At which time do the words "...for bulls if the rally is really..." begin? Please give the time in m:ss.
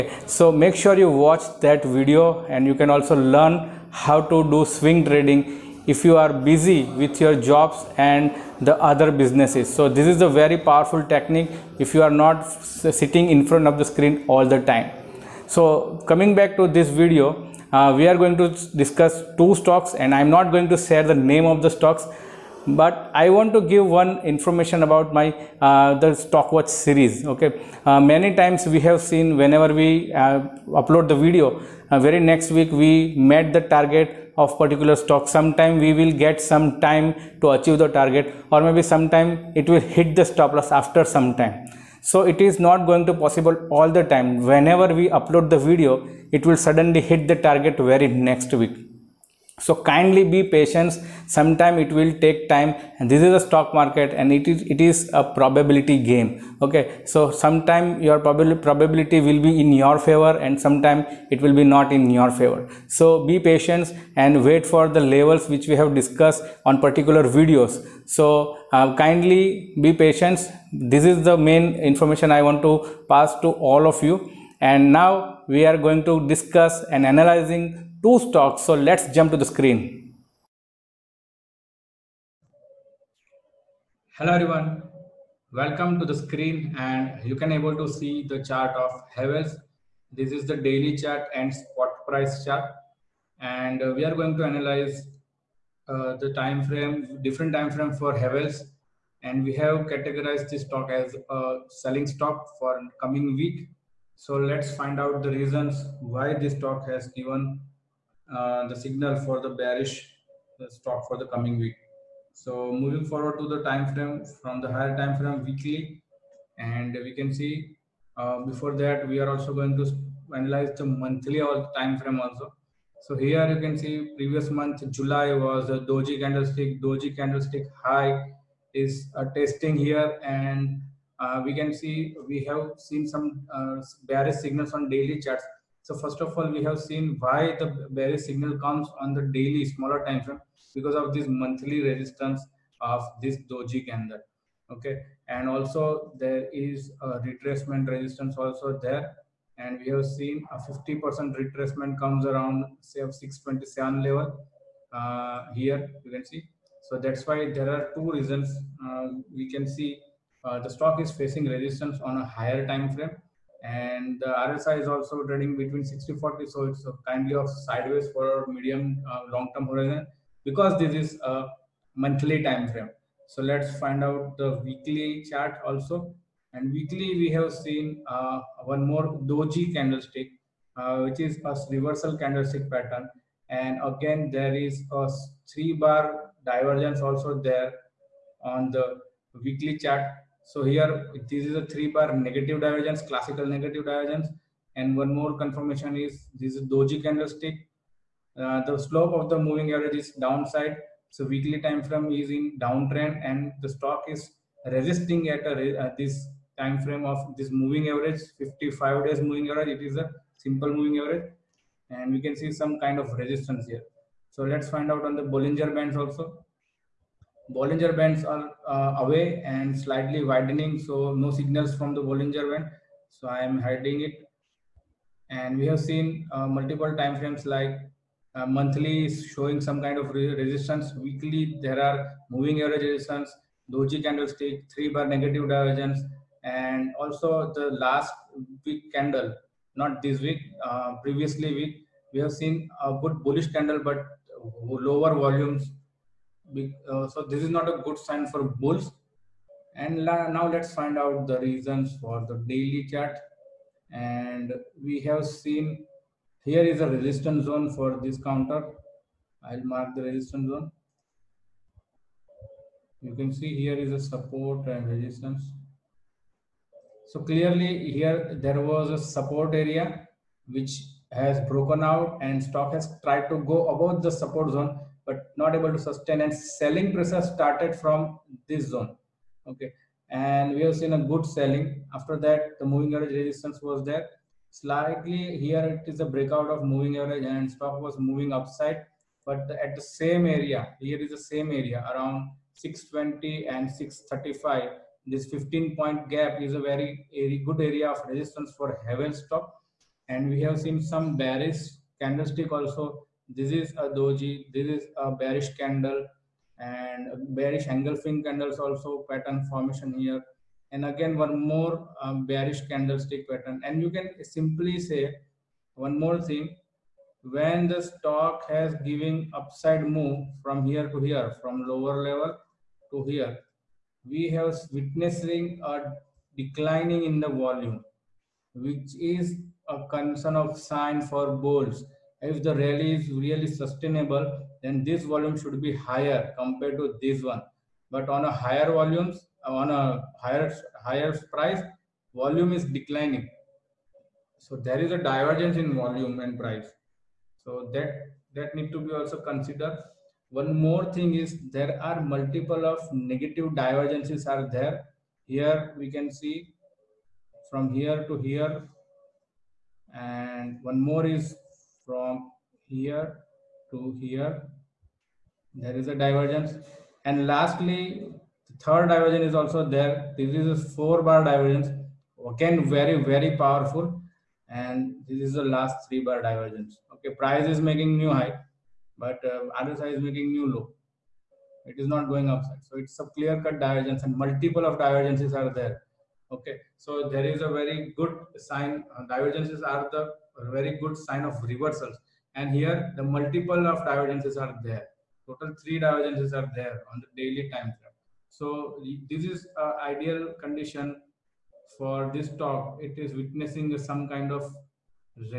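5:31.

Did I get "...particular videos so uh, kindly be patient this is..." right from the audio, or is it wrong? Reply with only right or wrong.
right.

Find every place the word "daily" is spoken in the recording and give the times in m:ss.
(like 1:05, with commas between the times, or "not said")
1:30, 2:14, 2:19, 4:12, 6:37.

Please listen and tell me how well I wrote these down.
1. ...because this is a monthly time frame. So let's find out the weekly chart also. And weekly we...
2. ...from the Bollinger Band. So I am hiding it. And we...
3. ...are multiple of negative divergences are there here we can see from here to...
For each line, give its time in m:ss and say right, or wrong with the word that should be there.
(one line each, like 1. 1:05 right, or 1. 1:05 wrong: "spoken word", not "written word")
1. 2:50 right
2. 3:41 right
3. 5:51 right.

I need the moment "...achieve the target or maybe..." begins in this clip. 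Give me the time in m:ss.
0:37.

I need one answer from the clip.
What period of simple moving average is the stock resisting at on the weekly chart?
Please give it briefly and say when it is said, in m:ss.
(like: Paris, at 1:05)
55, at 3:28.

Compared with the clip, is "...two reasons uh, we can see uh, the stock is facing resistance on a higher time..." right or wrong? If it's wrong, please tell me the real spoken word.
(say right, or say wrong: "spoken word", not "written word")
right.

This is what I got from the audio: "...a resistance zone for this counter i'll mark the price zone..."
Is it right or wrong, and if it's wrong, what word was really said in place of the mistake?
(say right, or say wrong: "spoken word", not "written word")
wrong: "resistance", not "price".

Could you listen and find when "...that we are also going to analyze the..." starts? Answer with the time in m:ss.
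1:58.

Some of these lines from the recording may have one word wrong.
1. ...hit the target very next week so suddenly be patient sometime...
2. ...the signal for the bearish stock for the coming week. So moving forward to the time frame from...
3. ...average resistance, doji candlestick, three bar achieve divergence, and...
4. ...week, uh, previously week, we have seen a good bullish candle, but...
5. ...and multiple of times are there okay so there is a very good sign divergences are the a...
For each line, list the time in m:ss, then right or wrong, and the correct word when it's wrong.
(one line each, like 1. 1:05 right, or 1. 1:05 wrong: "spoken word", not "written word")
1. 0:47 wrong: "kindly", not "suddenly"
2. 1:48 right
3. 3:52 wrong: "negative", not "achieve"
4. 4:00 right
5. 6:24 wrong: "divergences", not "times".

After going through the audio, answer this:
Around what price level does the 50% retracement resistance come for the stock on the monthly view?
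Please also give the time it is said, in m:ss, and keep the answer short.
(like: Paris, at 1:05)
627, at 2:33.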